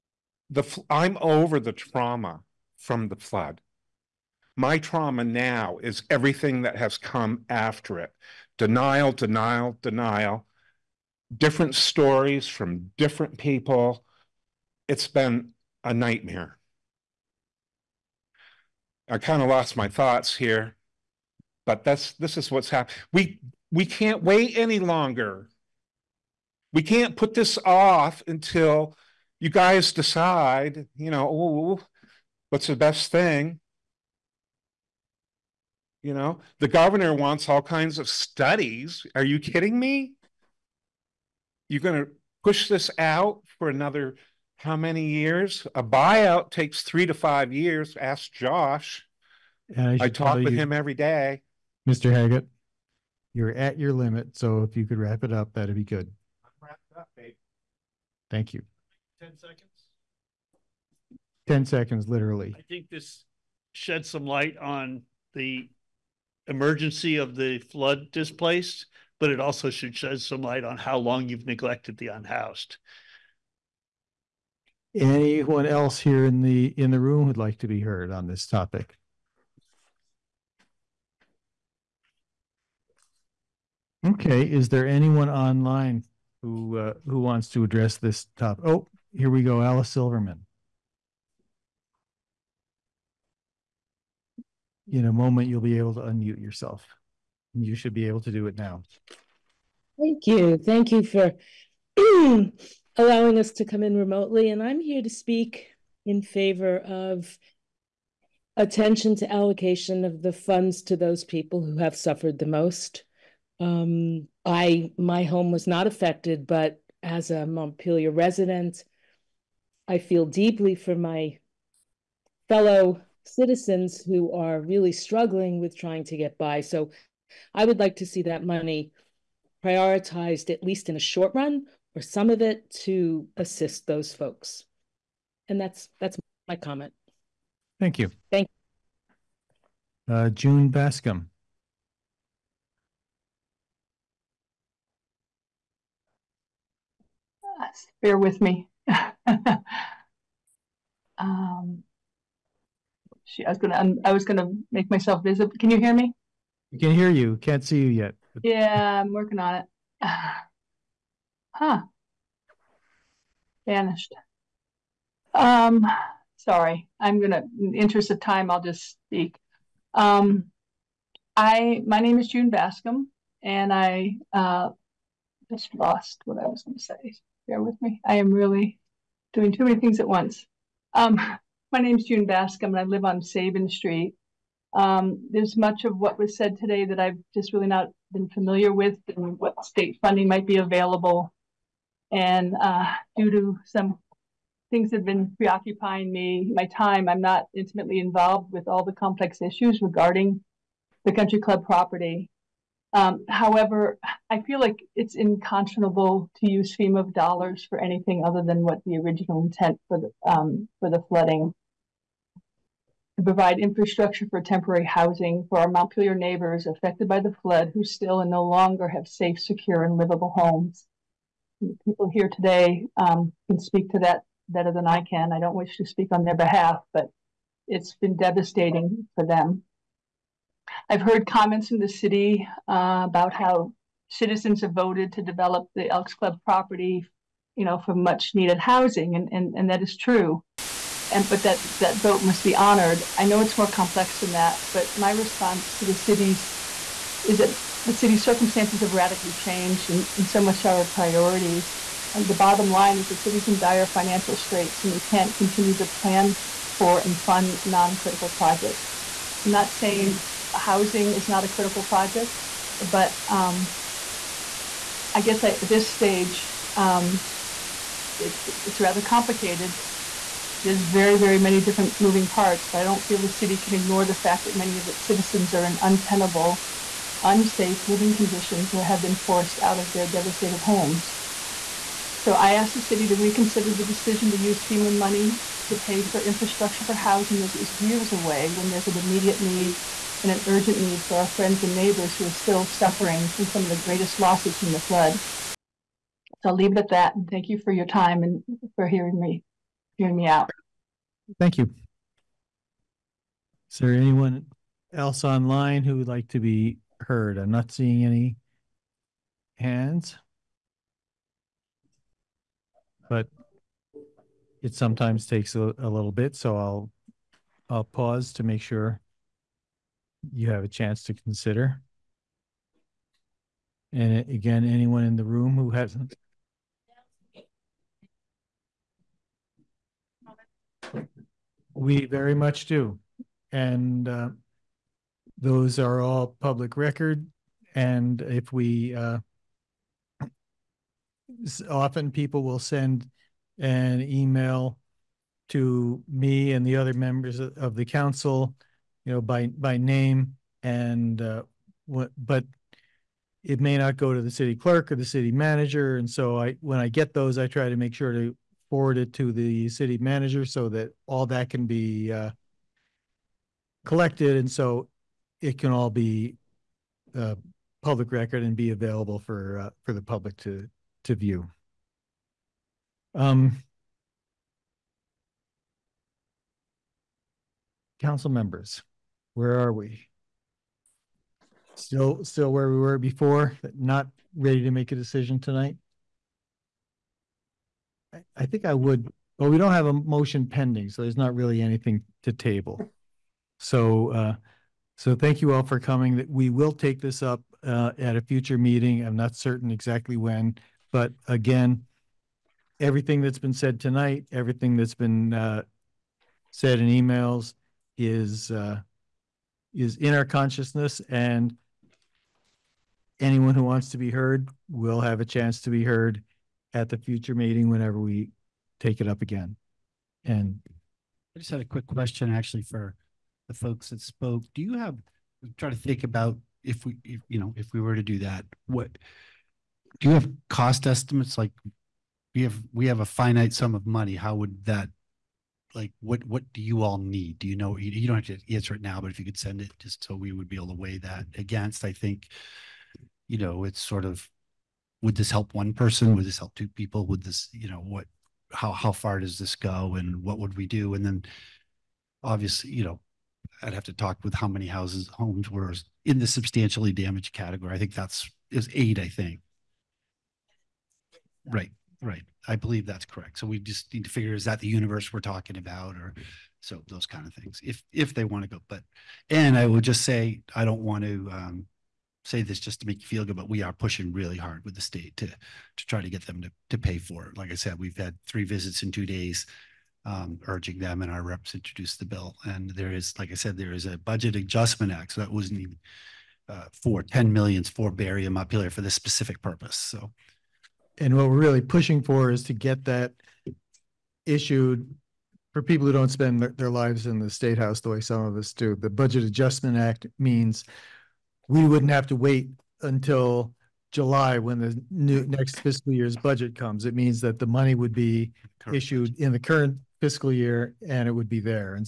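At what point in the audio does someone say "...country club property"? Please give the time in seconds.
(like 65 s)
201 s.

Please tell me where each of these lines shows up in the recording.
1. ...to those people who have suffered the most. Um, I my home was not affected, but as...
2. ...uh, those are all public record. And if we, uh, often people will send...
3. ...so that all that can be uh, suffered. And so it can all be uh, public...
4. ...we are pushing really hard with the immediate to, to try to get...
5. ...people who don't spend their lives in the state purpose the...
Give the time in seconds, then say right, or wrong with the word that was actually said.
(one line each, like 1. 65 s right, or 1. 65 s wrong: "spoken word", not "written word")
1. 110 s right
2. 334 s right
3. 360 s wrong: "collected", not "suffered"
4. 473 s wrong: "state", not "immediate"
5. 495 s wrong: "house", not "purpose".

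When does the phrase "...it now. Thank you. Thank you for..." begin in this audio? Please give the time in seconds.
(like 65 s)
98 s.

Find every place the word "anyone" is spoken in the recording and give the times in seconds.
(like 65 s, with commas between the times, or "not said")
74 s, 84 s, 303 s, 324 s, 413 s.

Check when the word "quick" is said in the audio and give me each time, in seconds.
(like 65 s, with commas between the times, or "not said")
421 s.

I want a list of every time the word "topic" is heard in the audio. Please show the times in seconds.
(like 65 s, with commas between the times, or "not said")
78 s, 88 s.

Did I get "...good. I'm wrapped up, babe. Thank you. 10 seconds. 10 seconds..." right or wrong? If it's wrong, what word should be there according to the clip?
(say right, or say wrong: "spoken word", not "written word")
right.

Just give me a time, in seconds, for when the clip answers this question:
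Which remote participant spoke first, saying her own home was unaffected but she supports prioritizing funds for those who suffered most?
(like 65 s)
89 s.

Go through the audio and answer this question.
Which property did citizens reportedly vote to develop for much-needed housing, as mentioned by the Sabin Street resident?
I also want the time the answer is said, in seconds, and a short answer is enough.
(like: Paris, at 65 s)
Elks Club, at 235 s.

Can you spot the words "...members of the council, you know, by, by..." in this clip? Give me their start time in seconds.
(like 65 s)
346 s.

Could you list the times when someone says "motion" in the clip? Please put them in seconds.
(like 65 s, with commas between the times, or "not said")
389 s.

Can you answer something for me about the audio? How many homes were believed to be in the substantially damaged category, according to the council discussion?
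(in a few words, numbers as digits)
8.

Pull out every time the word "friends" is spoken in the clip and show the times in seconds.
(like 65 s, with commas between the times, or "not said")
291 s.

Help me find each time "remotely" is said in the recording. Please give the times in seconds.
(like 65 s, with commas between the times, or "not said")
103 s.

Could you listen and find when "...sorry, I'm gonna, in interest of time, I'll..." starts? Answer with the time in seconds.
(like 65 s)
166 s.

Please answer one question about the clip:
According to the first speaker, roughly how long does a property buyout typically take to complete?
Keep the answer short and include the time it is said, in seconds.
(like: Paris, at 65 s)
3 to 5 years, at 46 s.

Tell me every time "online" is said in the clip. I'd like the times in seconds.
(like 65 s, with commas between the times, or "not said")
85 s, 305 s.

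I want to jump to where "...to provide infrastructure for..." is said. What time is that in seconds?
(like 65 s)
213 s.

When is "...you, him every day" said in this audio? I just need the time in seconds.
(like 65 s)
50 s.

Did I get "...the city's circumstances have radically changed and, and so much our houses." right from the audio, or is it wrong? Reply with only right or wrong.
wrong.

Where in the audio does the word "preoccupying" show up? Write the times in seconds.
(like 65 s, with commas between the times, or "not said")
195 s.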